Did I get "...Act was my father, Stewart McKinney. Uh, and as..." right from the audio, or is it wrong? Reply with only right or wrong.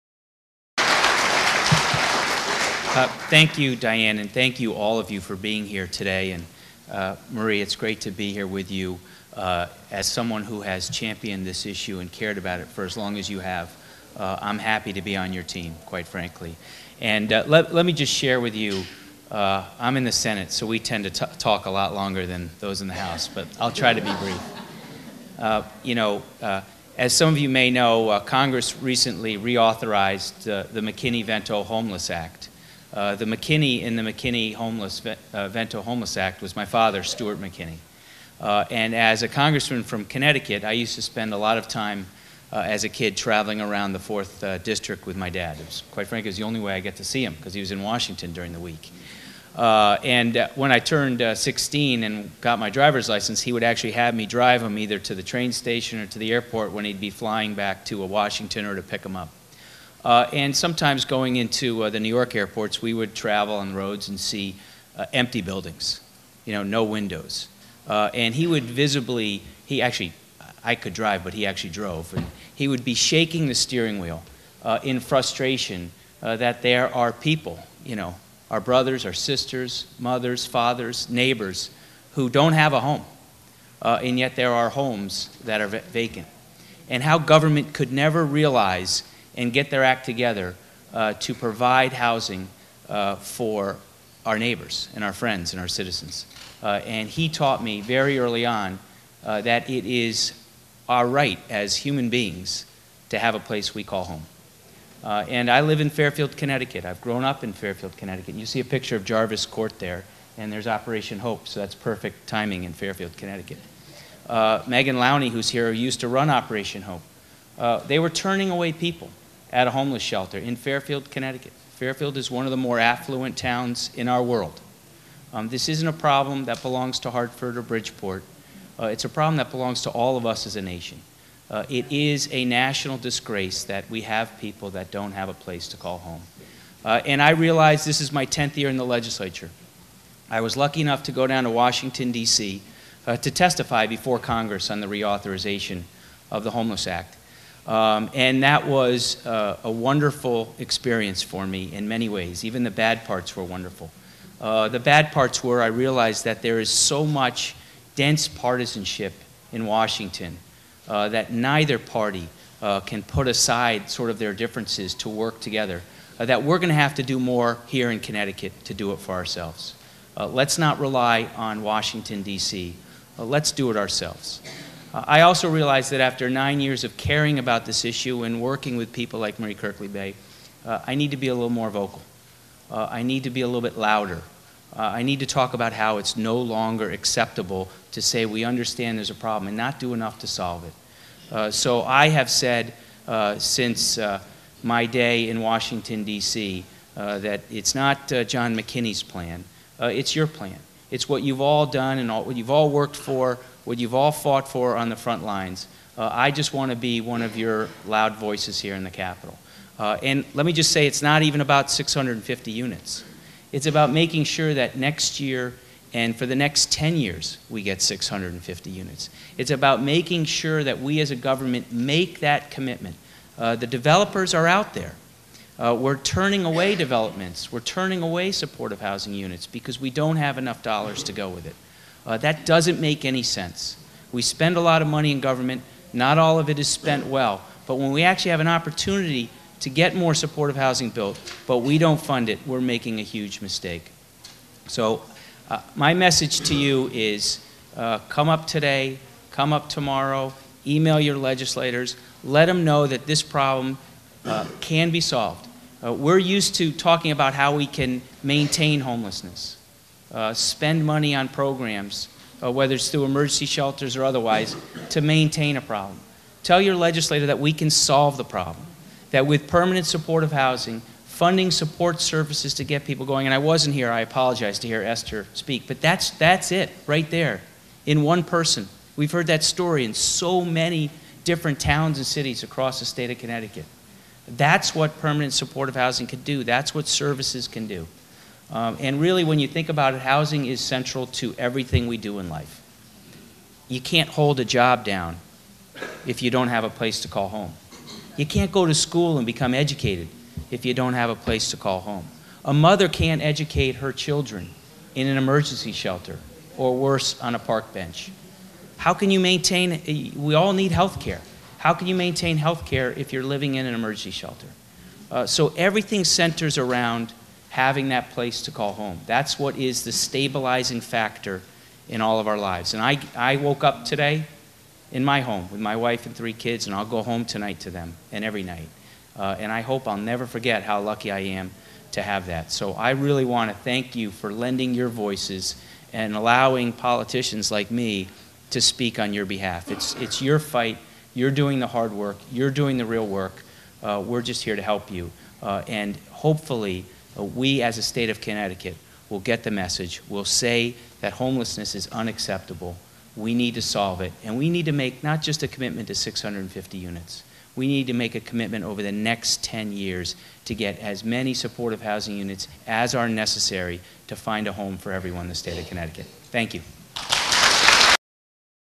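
right.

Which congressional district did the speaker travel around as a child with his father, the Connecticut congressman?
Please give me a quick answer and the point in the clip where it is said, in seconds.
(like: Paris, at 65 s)
4th District, at 43 s.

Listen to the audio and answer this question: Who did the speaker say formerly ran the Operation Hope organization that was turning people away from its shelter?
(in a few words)
Megan Lowney.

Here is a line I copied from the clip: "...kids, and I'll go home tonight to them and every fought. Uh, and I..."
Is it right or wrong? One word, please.
wrong.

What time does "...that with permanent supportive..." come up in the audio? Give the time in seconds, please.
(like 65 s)
269 s.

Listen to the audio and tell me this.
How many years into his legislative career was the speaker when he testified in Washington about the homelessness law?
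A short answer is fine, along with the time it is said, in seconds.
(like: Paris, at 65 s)
10th year, at 138 s.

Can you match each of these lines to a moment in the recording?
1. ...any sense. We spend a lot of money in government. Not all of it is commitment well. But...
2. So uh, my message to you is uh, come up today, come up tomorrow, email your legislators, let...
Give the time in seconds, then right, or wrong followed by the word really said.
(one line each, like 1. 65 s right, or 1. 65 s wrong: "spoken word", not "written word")
1. 233 s wrong: "spent", not "commitment"
2. 244 s right.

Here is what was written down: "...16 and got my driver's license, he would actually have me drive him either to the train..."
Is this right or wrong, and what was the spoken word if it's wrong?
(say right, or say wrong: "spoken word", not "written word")
right.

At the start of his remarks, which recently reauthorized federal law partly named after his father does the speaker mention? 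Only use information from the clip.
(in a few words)
McKinney Vento Homeless Act.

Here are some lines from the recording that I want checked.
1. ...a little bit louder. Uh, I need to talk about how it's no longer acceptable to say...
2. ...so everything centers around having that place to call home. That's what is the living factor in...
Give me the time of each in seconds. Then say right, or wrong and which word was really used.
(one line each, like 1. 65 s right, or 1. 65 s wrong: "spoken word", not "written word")
1. 183 s right
2. 315 s wrong: "stabilizing", not "living".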